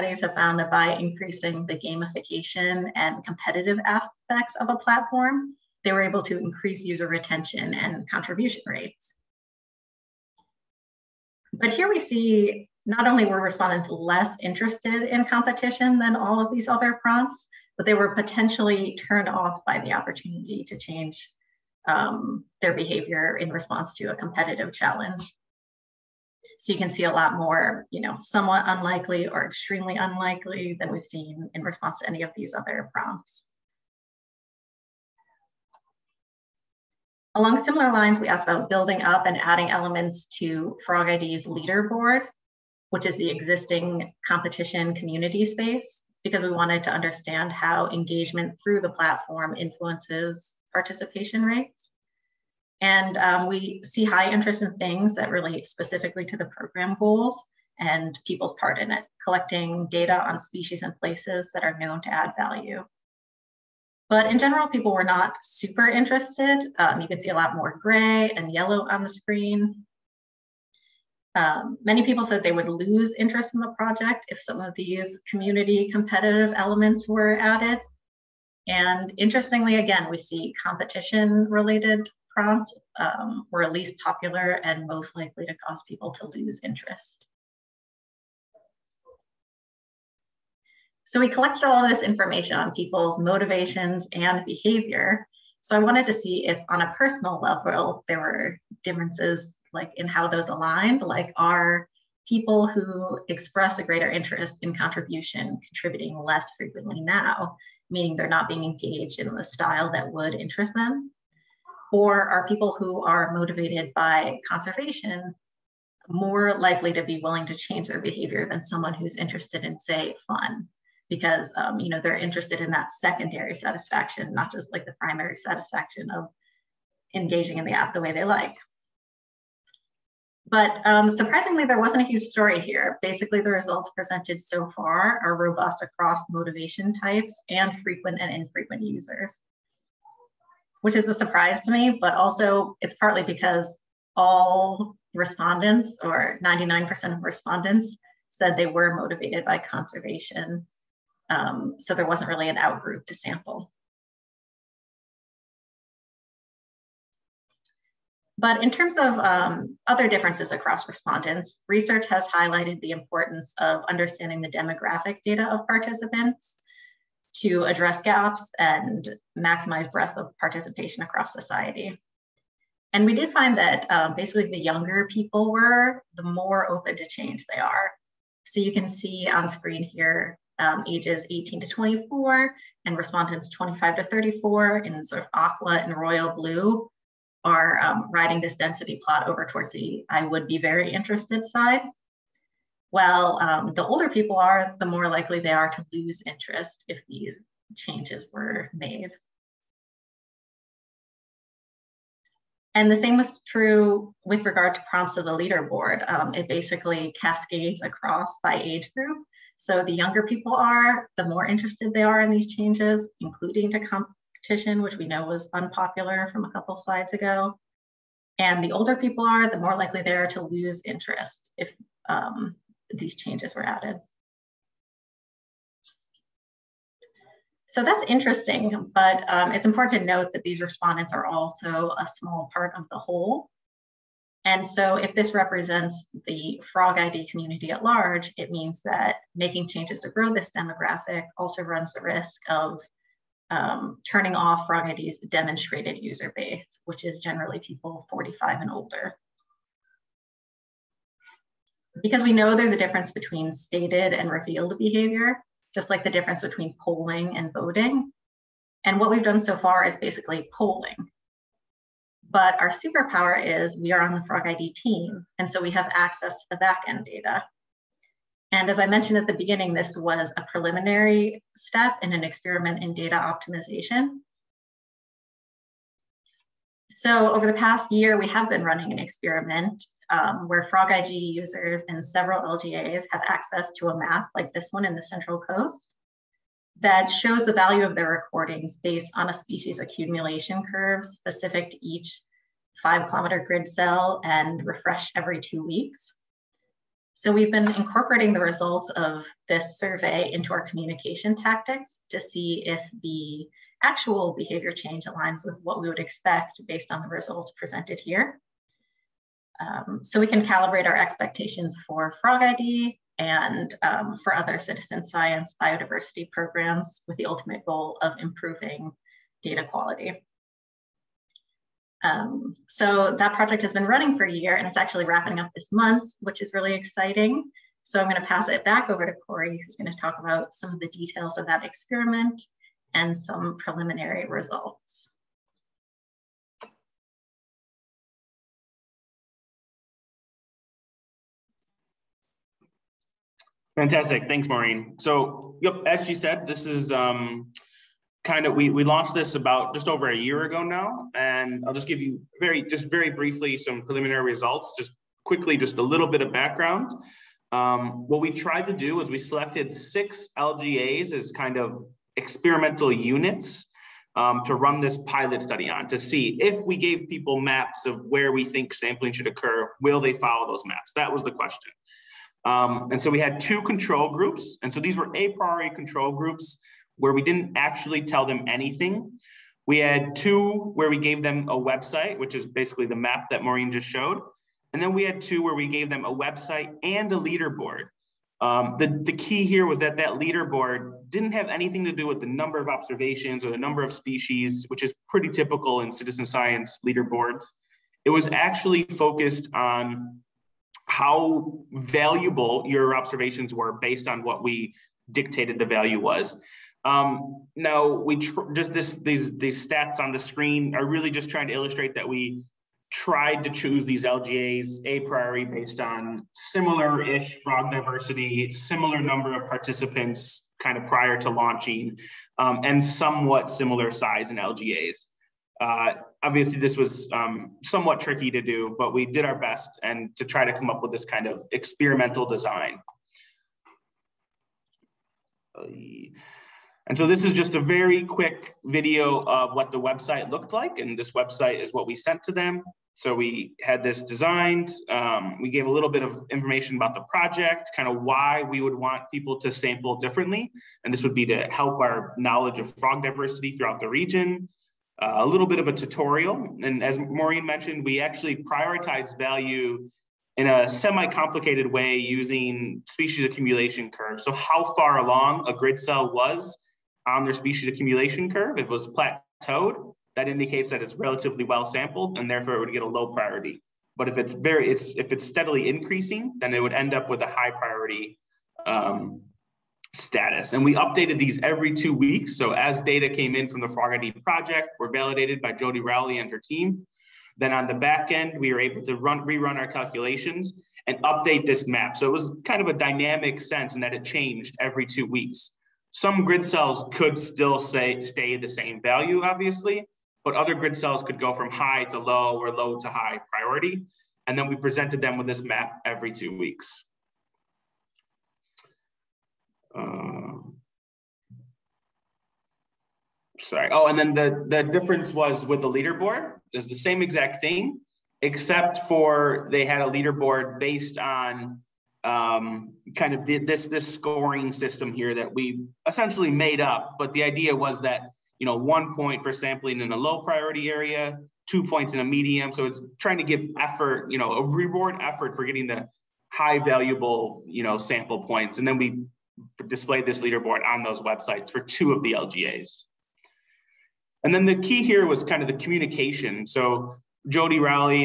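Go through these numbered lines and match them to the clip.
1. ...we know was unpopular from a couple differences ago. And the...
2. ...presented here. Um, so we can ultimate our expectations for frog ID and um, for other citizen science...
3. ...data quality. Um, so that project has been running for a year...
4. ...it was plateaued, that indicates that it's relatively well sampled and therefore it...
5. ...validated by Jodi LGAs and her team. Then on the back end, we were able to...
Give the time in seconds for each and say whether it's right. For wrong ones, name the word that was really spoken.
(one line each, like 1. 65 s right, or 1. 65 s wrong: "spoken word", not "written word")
1. 214 s wrong: "slides", not "differences"
2. 307 s wrong: "calibrate", not "ultimate"
3. 319 s right
4. 468 s right
5. 484 s wrong: "Rowley", not "LGAs".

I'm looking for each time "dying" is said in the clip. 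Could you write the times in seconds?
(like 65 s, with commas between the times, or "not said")
not said.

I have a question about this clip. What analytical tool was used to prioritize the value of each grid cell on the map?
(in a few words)
species accumulation curves.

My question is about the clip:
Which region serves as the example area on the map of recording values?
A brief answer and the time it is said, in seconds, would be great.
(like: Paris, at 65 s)
Central Coast, at 285 s.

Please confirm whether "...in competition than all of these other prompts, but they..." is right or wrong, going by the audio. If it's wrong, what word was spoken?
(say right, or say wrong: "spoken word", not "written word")
right.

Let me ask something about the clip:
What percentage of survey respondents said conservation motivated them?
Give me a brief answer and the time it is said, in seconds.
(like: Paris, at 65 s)
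99%, at 146 s.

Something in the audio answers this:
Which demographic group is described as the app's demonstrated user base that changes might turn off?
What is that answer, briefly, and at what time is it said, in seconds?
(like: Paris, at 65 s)
people 45 and older, at 247 s.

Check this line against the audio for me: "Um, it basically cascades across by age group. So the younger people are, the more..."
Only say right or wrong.
right.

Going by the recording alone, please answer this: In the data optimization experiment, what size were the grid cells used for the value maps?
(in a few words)
5 kilometers.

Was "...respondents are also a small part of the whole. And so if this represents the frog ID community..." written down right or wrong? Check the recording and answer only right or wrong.
right.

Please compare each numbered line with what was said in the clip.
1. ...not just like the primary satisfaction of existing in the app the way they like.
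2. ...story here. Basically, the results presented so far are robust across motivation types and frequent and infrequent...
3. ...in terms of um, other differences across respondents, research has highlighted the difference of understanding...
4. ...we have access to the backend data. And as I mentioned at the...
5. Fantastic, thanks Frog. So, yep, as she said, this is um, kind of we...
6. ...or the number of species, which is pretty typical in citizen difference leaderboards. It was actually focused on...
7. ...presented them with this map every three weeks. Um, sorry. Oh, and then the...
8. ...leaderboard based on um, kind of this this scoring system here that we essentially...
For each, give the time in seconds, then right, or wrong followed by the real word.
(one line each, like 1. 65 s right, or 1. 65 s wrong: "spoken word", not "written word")
1. 124 s wrong: "engaging", not "existing"
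2. 132 s right
3. 158 s wrong: "importance", not "difference"
4. 265 s right
5. 343 s wrong: "Maureen", not "Frog"
6. 393 s wrong: "science", not "difference"
7. 504 s wrong: "two", not "three"
8. 519 s right.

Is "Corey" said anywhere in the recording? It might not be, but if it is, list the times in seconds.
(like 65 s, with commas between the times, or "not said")
329 s.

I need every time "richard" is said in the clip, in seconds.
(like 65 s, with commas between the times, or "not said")
not said.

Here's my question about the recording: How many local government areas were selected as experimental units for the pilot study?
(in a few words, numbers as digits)
6.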